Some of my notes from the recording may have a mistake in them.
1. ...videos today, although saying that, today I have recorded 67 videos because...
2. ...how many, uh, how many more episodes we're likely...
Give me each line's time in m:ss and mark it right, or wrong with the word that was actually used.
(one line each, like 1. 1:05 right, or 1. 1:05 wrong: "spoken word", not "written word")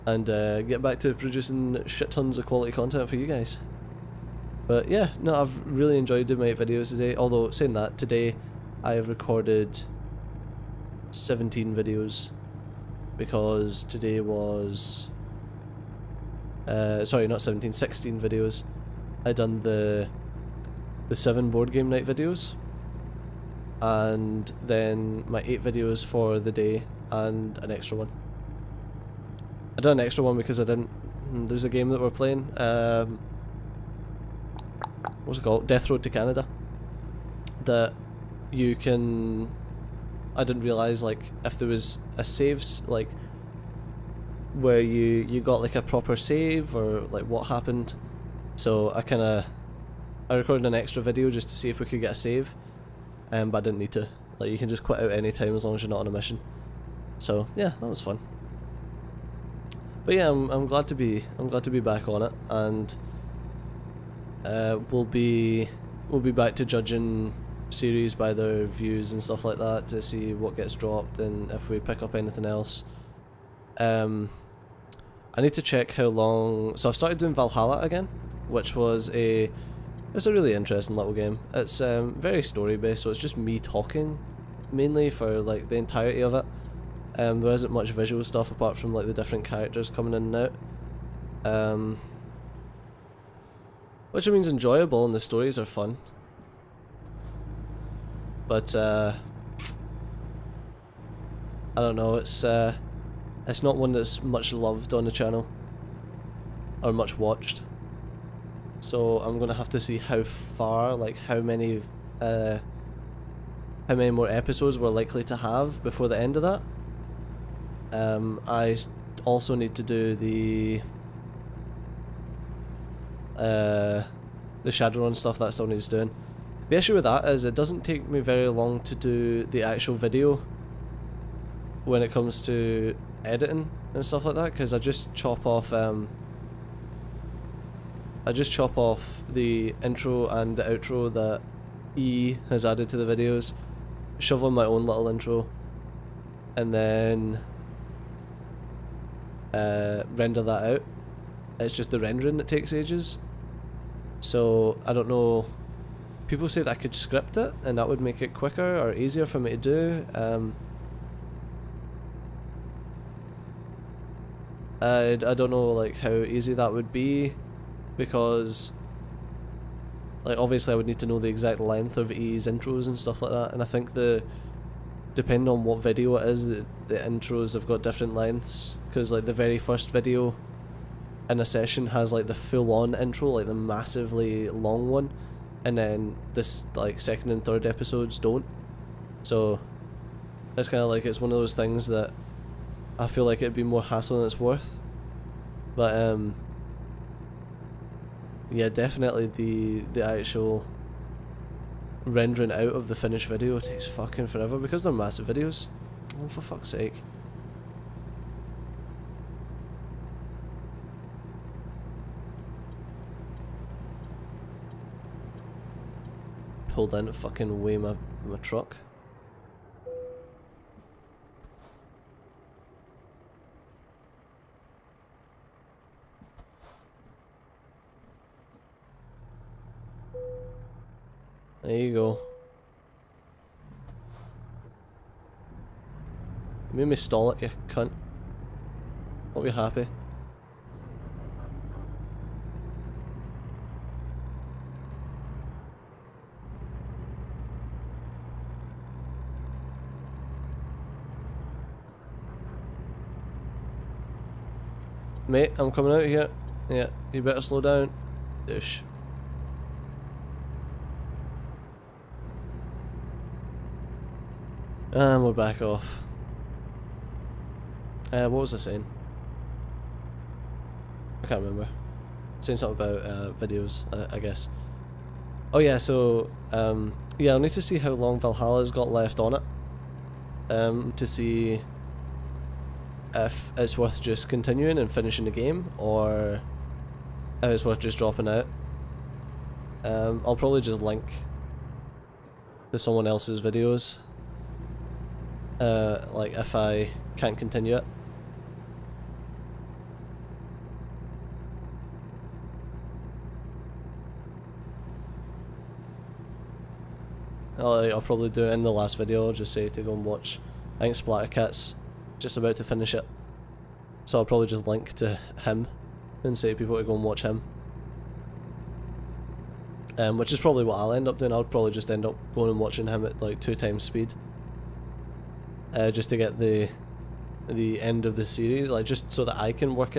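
1. 0:06 wrong: "17", not "67"
2. 1:51 right.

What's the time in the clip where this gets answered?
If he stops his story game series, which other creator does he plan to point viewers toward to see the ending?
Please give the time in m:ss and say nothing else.
5:10.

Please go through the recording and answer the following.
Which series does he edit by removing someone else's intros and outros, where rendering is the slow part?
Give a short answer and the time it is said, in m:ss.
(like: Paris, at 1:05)
Shadowrun, at 2:04.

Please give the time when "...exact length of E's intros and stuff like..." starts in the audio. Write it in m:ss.
2:51.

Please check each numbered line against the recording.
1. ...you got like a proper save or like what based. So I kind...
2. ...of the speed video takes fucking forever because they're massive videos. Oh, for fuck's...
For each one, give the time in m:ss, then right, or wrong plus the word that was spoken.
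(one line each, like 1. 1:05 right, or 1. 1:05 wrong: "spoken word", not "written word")
1. 0:45 wrong: "happened", not "based"
2. 3:22 wrong: "finished", not "speed".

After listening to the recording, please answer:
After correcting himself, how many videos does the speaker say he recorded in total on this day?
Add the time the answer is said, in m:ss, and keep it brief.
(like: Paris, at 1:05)
16, at 0:17.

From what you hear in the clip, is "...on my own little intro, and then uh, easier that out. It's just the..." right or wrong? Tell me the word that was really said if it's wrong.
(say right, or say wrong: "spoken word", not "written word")
wrong: "render", not "easier".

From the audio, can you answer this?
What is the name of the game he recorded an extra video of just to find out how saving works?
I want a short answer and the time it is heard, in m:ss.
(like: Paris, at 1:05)
Death Road to Canada, at 0:35.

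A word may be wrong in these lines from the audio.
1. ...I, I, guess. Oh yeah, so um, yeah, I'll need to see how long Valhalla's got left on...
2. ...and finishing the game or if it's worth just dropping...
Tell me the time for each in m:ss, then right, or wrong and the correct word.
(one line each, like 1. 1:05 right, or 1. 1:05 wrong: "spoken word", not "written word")
1. 4:33 right
2. 4:44 right.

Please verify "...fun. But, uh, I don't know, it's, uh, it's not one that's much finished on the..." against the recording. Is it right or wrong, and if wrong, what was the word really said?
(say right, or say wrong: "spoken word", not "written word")
wrong: "loved", not "finished".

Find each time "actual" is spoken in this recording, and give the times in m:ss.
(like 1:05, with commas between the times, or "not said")
2:09, 3:20.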